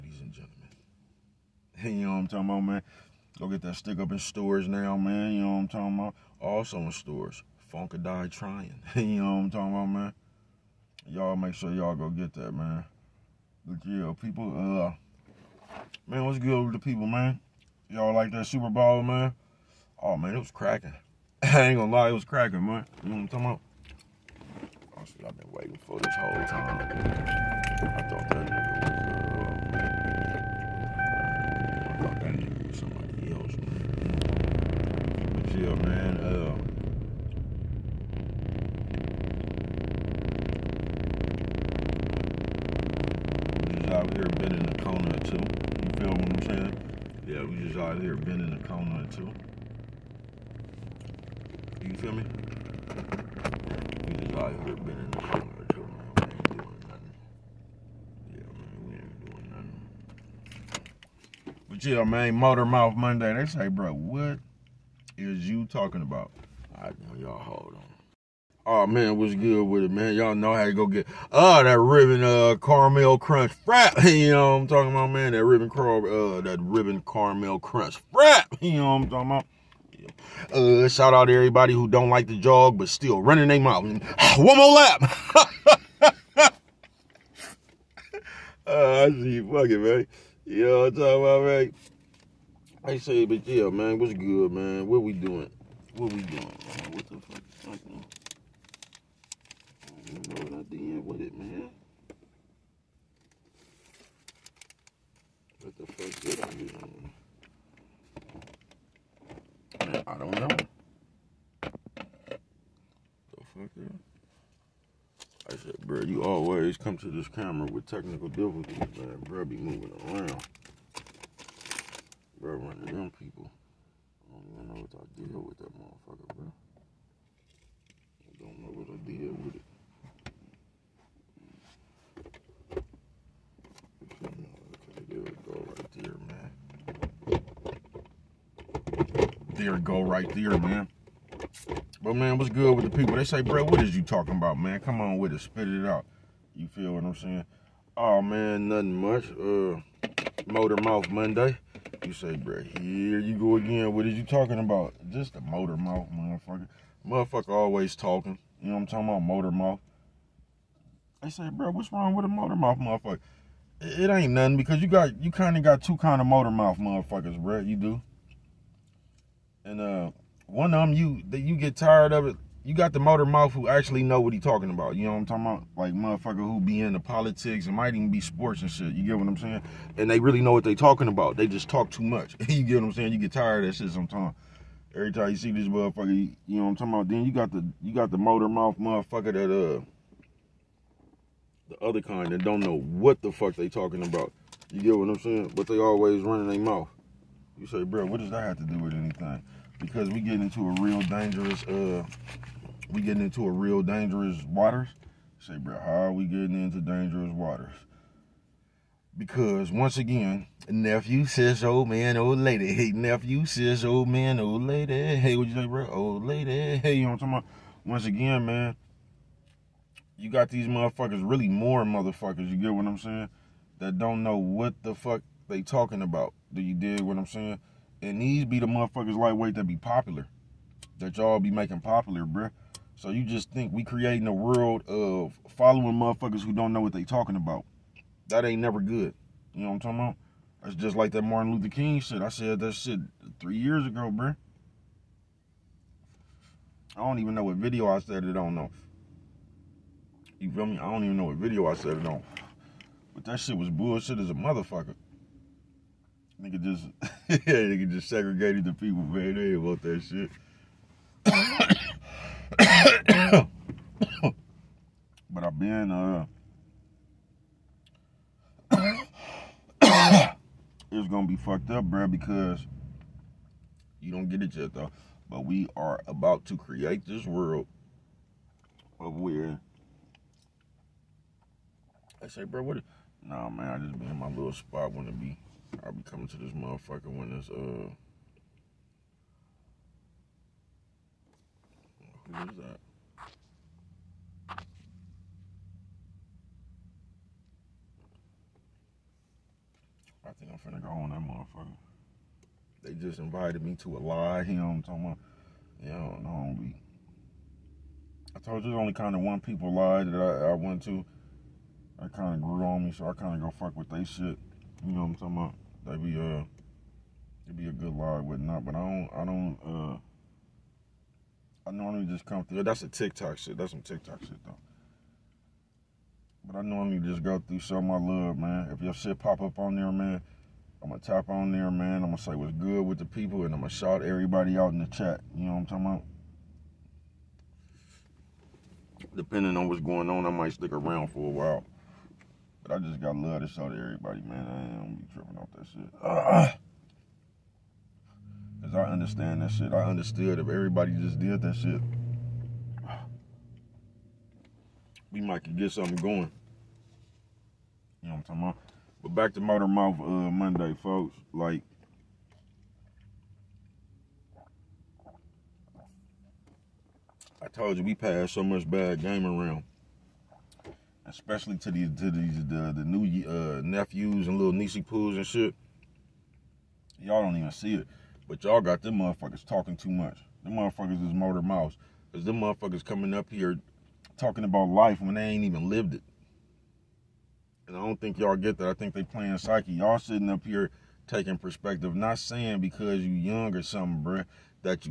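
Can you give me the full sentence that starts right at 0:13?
But yeah, people, uh, man, what's good with the people, man?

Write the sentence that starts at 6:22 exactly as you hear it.
Cause them motherfuckers coming up here talking about life when they ain't even lived it.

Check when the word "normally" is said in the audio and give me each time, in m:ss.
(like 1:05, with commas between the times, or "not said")
5:21, 5:26.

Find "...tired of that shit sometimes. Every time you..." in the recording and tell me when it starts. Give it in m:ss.
3:03.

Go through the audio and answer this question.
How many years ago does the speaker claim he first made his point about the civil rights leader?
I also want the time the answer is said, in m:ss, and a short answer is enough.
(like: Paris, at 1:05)
3, at 4:03.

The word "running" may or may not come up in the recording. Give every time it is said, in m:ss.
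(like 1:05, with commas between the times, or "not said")
1:23, 2:02, 3:16.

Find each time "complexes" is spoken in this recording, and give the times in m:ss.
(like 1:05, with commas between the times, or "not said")
not said.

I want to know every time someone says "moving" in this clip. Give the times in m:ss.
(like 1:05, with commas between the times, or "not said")
1:59.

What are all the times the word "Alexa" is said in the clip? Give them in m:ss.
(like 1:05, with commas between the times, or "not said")
not said.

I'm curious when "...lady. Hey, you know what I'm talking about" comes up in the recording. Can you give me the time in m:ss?
3:36.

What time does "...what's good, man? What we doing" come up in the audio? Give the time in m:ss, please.
1:33.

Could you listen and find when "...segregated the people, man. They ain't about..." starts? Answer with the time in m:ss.
4:18.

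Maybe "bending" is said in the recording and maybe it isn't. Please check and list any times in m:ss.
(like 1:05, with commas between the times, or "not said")
0:48, 0:54.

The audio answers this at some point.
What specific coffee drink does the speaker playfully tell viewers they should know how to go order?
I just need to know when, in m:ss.
1:11.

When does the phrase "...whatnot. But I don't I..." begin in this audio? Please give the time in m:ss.
5:18.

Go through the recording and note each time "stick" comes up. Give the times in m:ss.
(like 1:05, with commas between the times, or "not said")
0:03, 5:40.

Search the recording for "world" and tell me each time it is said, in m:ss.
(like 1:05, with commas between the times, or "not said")
3:54, 4:37.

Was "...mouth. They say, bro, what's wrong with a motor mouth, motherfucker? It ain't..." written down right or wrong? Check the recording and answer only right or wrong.
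right.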